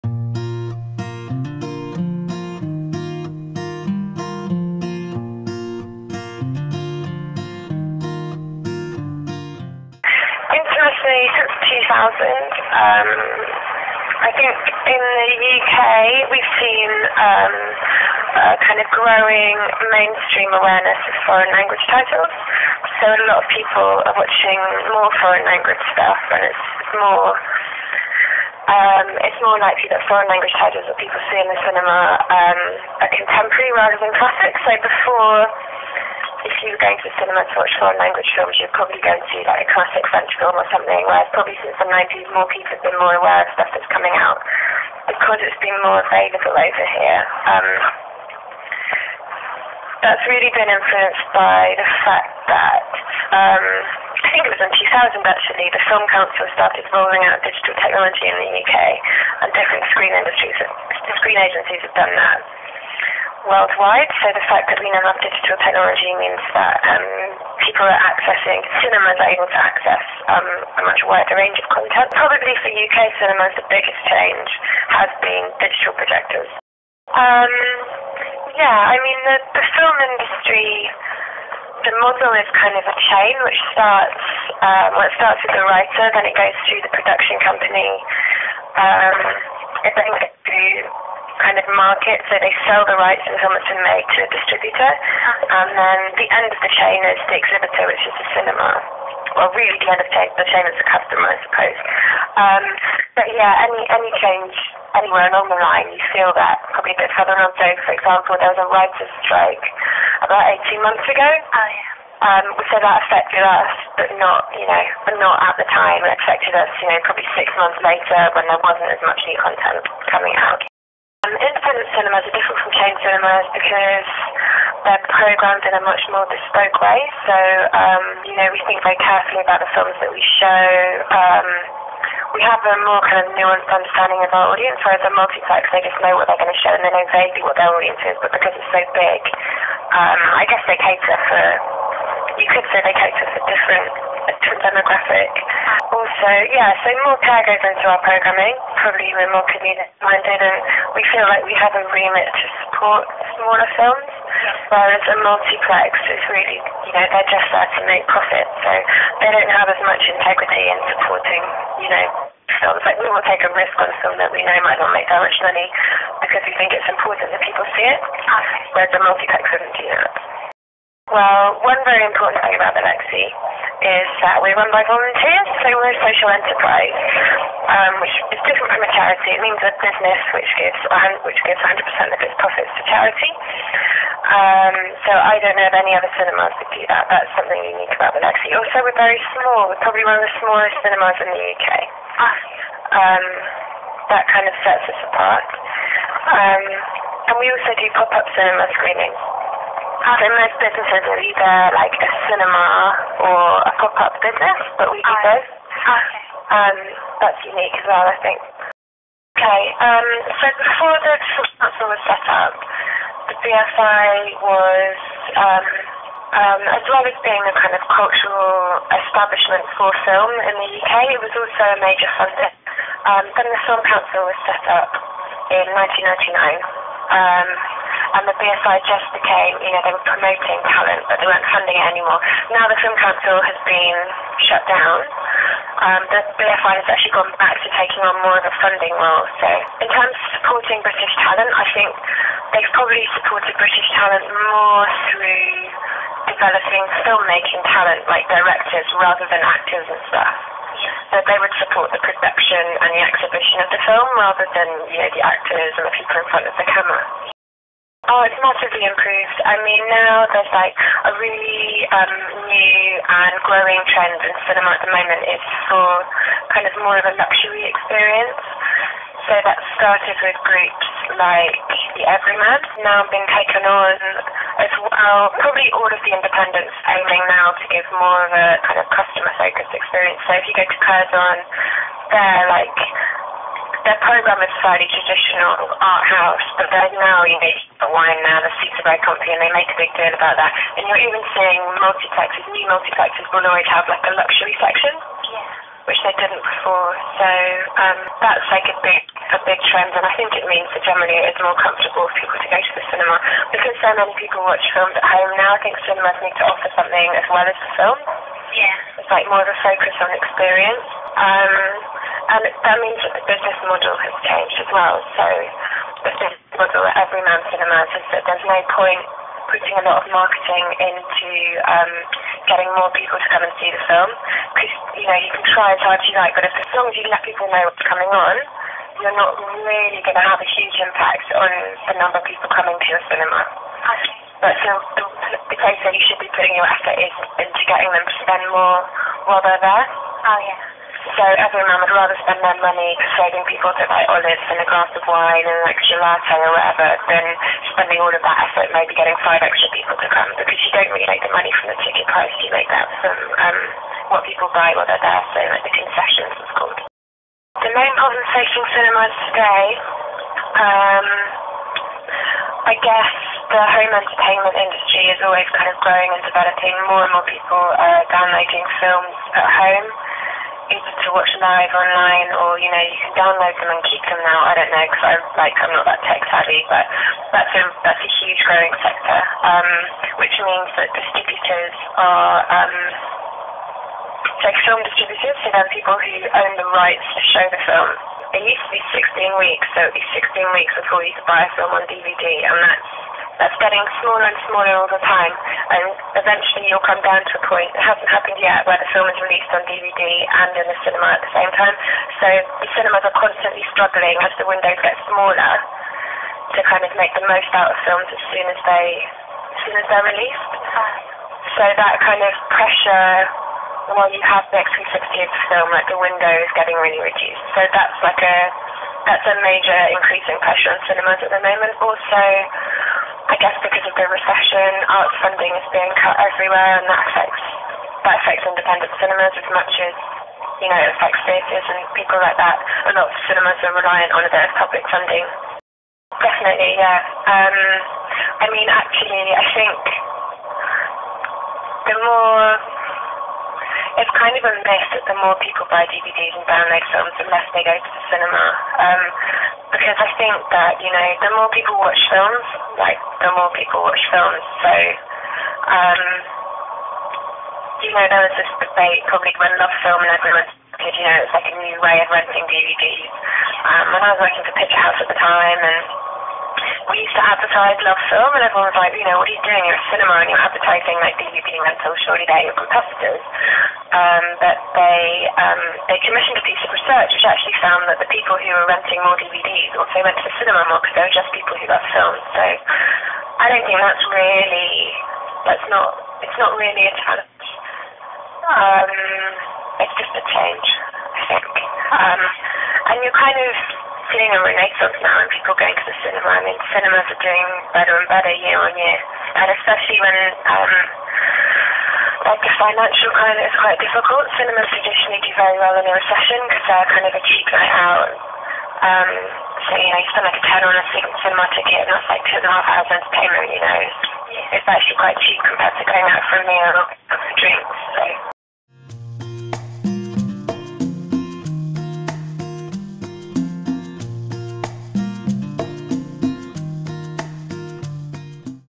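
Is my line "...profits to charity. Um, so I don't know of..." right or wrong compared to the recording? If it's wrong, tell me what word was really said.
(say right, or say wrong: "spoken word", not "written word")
right.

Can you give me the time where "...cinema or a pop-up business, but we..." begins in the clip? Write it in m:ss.
3:22.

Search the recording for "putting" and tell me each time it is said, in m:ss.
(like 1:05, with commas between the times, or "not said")
5:19, 5:36.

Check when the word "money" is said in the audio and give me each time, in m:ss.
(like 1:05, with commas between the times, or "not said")
2:45, 5:42, 5:51.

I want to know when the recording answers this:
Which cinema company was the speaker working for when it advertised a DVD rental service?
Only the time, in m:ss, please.
7:44.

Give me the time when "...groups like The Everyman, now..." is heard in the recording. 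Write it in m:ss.
4:30.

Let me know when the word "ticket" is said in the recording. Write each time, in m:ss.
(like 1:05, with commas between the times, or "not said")
5:51, 8:31.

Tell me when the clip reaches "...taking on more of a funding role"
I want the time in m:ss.
3:57.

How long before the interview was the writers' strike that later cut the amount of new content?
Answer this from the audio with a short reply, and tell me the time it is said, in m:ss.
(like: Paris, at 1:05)
18 months, at 1:50.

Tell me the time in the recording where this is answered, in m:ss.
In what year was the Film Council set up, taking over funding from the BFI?
3:45.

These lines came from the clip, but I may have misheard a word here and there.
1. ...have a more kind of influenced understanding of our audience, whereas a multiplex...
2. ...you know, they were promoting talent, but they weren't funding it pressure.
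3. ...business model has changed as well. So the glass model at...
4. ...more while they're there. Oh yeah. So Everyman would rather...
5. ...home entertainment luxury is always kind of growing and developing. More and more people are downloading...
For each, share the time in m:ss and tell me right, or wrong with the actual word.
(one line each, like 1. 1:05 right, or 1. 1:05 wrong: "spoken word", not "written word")
1. 2:12 wrong: "nuanced", not "influenced"
2. 3:49 wrong: "anymore", not "pressure"
3. 5:13 wrong: "business", not "glass"
4. 5:38 right
5. 6:03 wrong: "industry", not "luxury".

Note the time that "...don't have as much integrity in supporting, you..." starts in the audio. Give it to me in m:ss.
2:39.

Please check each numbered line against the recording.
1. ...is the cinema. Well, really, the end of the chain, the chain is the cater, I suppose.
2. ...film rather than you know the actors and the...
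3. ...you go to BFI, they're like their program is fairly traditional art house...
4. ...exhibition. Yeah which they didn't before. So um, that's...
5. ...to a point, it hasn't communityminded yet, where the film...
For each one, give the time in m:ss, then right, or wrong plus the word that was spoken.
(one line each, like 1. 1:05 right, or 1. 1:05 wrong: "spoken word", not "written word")
1. 1:38 wrong: "customer", not "cater"
2. 4:13 right
3. 4:40 wrong: "Curzon", not "BFI"
4. 4:54 wrong: "section", not "exhibition"
5. 6:37 wrong: "happened", not "communityminded".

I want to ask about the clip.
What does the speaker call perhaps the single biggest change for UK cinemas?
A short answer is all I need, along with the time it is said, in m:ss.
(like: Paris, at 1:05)
Digital projectors, at 1:15.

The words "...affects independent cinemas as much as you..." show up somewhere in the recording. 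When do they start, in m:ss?
7:08.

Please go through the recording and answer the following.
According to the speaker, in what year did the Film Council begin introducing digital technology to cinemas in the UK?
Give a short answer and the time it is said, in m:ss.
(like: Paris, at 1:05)
2000, at 0:54.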